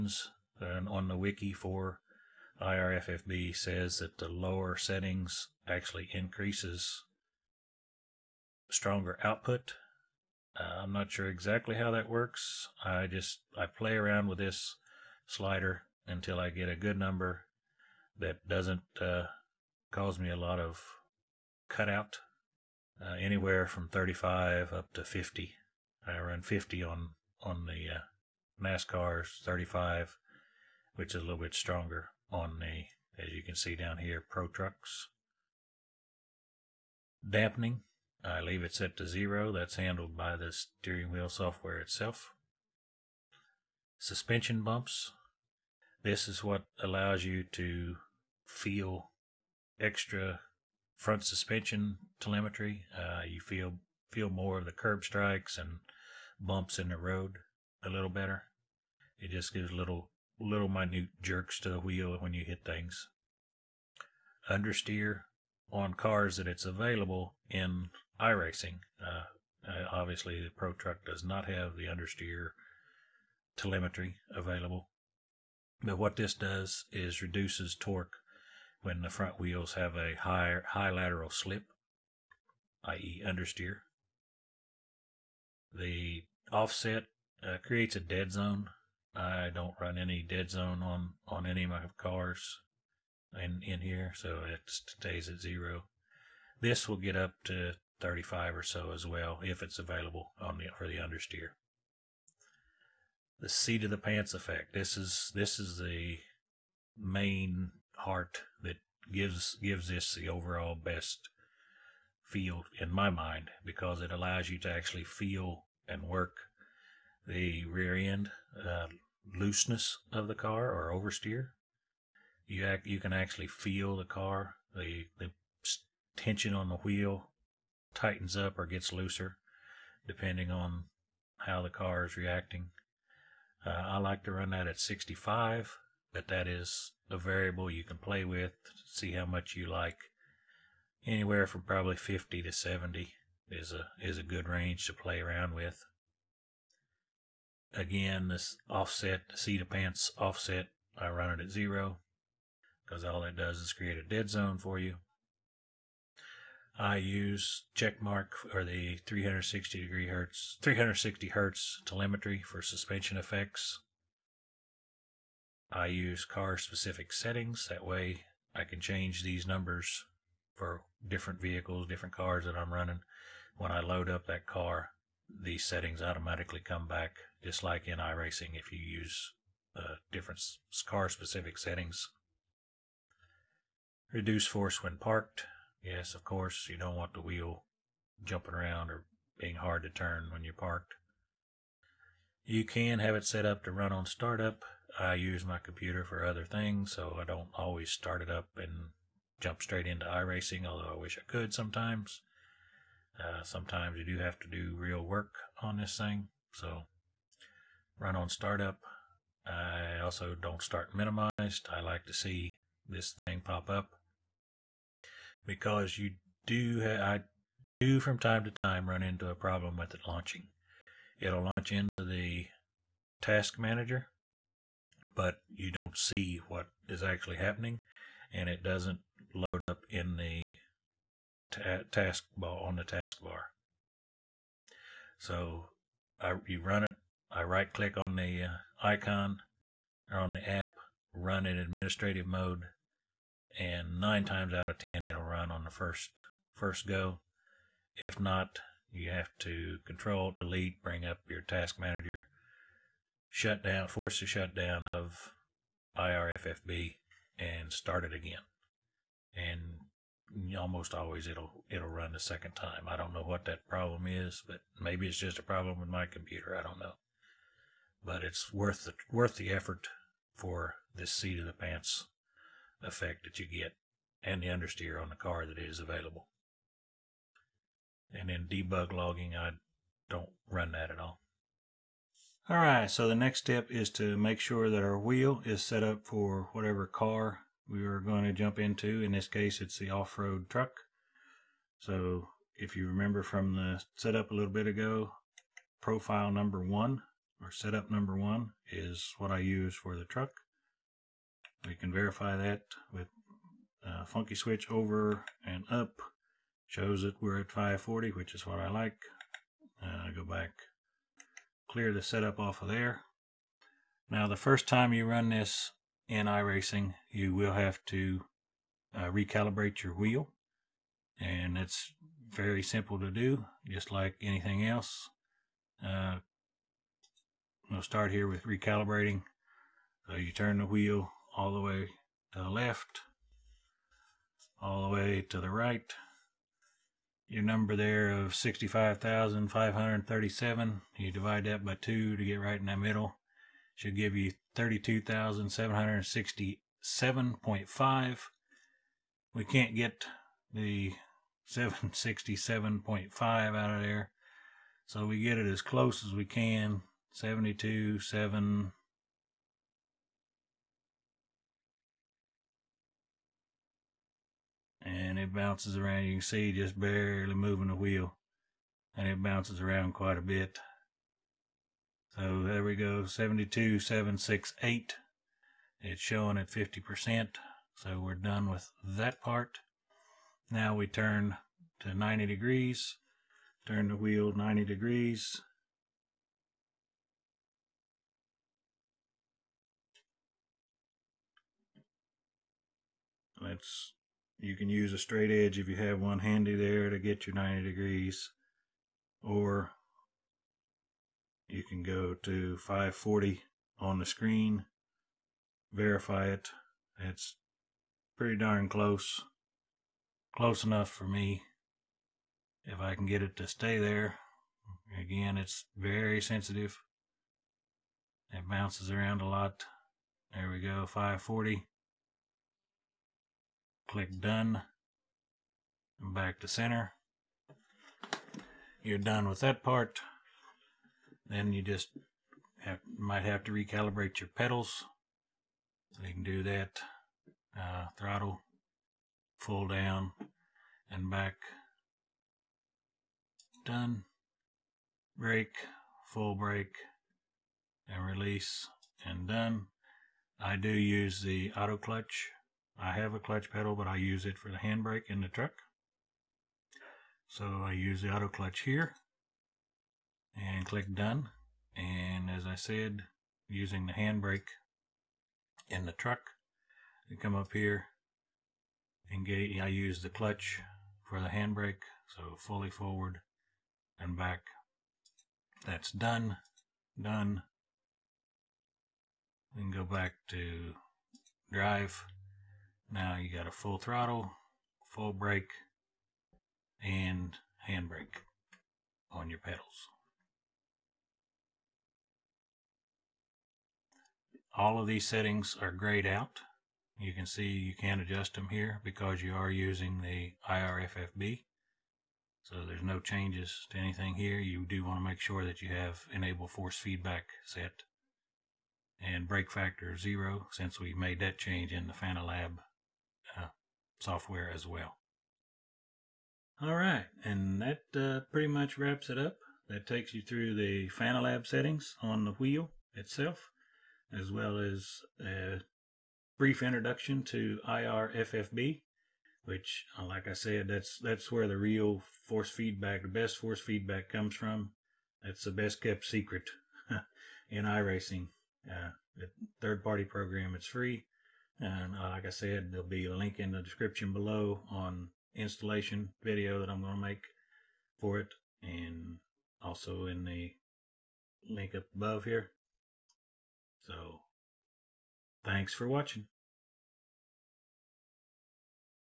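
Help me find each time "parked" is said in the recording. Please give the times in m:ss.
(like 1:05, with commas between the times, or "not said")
3:04, 3:10.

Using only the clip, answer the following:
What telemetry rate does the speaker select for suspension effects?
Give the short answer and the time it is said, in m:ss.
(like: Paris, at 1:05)
360 hertz, at 2:40.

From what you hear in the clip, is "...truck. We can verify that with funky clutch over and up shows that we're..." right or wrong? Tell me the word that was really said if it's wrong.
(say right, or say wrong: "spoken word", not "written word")
wrong: "switch", not "clutch".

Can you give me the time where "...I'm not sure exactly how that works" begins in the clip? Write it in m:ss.
0:10.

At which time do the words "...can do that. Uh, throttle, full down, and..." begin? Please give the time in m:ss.
7:16.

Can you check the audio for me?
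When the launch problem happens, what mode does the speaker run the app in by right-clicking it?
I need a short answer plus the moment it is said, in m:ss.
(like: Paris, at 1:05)
administrative mode, at 4:01.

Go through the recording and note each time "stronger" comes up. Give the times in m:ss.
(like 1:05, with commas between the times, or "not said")
0:08, 0:31.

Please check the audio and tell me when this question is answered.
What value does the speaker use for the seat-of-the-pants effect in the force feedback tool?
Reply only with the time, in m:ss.
2:14.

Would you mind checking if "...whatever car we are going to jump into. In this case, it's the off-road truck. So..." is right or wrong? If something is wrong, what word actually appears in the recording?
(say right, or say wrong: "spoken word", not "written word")
right.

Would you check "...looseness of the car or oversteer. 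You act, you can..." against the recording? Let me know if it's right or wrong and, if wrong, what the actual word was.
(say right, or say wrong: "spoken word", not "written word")
right.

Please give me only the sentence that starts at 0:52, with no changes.
Uh, you feel feel more of the curb strikes and bumps in the road a little better.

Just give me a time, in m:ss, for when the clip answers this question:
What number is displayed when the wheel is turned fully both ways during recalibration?
6:13.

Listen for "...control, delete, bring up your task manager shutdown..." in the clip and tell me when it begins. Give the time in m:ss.
4:09.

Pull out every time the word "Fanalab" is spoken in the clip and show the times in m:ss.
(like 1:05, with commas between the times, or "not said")
8:31, 8:40.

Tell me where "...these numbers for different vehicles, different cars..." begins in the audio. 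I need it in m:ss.
2:49.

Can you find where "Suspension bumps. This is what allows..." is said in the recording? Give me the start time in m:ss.
0:43.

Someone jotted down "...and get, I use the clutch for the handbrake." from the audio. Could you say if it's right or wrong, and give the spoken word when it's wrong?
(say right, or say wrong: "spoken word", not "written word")
right.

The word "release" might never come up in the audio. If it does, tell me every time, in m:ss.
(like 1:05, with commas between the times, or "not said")
7:28.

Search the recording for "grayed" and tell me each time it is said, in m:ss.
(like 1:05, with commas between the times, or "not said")
8:15.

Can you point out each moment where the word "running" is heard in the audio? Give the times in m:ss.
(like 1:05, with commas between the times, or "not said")
2:52.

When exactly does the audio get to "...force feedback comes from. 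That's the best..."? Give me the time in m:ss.
8:53.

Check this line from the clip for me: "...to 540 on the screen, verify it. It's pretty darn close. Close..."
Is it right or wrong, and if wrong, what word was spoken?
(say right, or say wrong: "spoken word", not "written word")
right.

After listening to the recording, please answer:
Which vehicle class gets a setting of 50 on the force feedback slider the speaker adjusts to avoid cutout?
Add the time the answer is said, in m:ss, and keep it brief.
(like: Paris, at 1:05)
NASCARs, at 0:28.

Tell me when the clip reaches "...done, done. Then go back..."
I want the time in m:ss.
7:55.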